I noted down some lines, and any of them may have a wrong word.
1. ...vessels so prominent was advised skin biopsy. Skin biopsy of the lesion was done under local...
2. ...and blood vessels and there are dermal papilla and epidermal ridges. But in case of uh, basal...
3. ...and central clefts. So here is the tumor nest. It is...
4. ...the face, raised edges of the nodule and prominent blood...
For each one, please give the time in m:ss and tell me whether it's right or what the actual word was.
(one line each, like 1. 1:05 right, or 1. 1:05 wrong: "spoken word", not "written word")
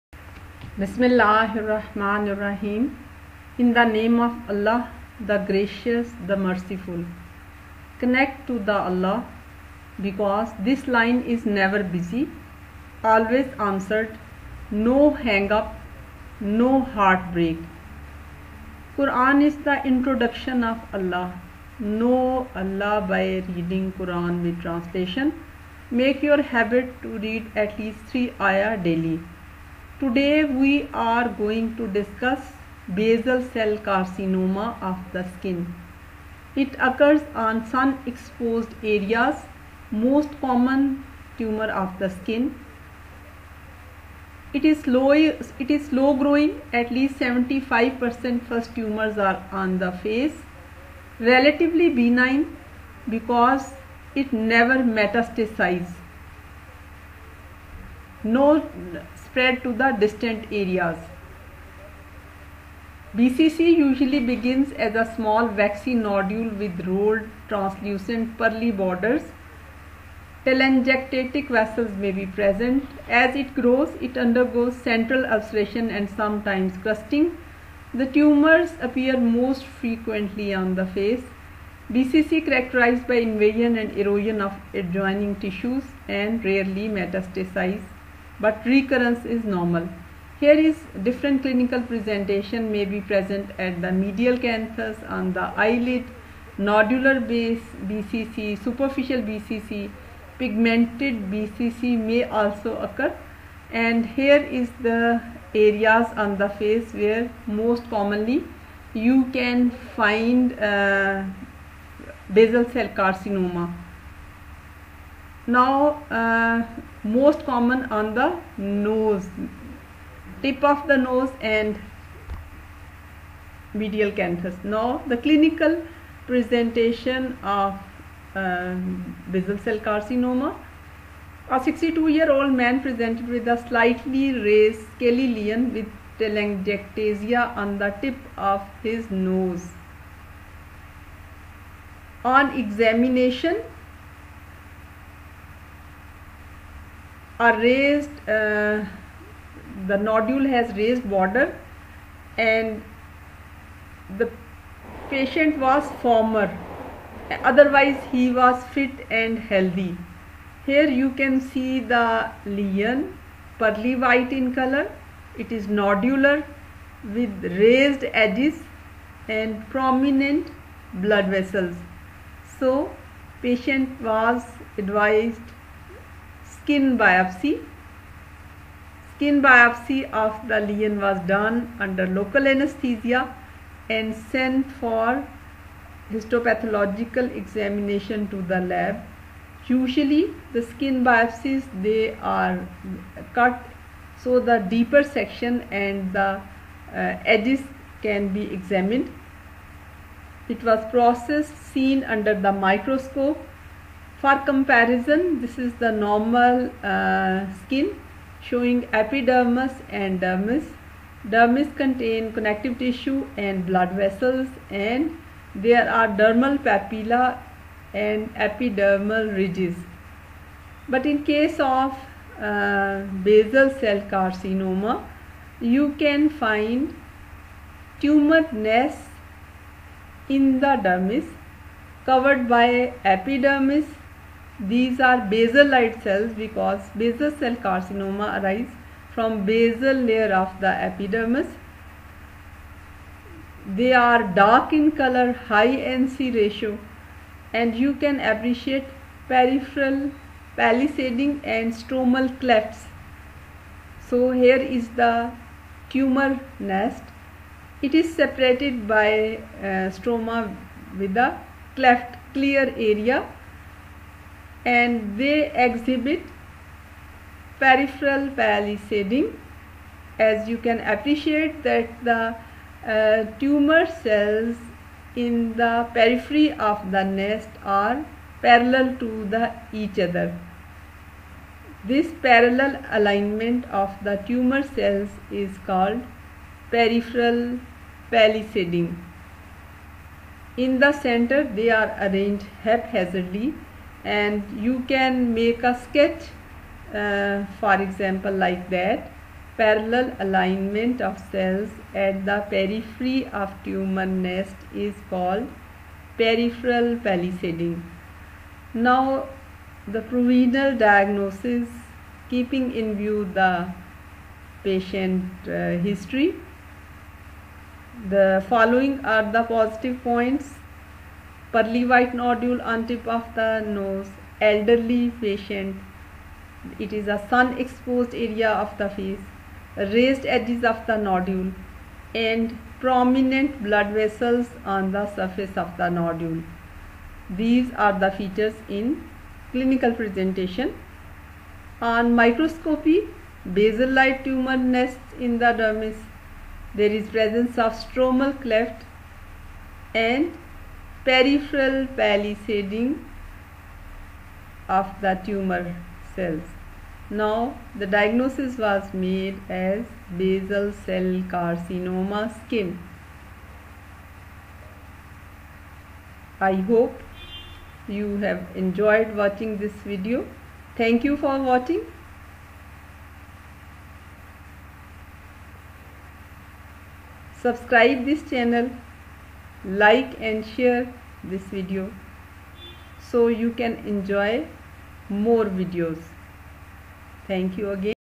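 1. 2:51 wrong: "patient", not "prominent"
2. 3:33 right
3. 4:11 wrong: "stromal", not "central"
4. 5:28 right.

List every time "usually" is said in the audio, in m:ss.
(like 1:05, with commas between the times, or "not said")
1:03, 3:09.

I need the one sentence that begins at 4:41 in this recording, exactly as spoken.
This parallel alignment of the tumor cells is called peripheral palisading.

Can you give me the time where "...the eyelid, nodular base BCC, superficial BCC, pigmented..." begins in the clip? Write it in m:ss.
1:35.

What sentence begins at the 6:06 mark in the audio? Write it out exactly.
I hope you have enjoyed watching this video.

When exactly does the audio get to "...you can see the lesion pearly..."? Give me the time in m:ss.
2:41.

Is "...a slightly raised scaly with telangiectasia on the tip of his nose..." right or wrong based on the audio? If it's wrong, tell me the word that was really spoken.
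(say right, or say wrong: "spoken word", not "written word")
right.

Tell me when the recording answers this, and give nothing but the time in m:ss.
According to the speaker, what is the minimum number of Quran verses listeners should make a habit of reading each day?
0:28.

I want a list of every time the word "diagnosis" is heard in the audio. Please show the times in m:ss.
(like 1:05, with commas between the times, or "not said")
5:10, 5:57.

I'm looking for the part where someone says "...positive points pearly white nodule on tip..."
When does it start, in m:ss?
5:19.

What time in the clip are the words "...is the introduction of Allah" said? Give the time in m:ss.
0:19.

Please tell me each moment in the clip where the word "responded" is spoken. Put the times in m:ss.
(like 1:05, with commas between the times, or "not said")
not said.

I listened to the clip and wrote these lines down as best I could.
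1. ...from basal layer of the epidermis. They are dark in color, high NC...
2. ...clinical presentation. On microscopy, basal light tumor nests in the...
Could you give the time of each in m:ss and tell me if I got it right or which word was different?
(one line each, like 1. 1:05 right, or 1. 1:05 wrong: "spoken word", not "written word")
1. 3:59 right
2. 5:39 right.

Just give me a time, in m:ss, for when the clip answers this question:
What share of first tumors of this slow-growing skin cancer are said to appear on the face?
0:46.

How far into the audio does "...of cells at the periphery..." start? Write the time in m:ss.
5:01.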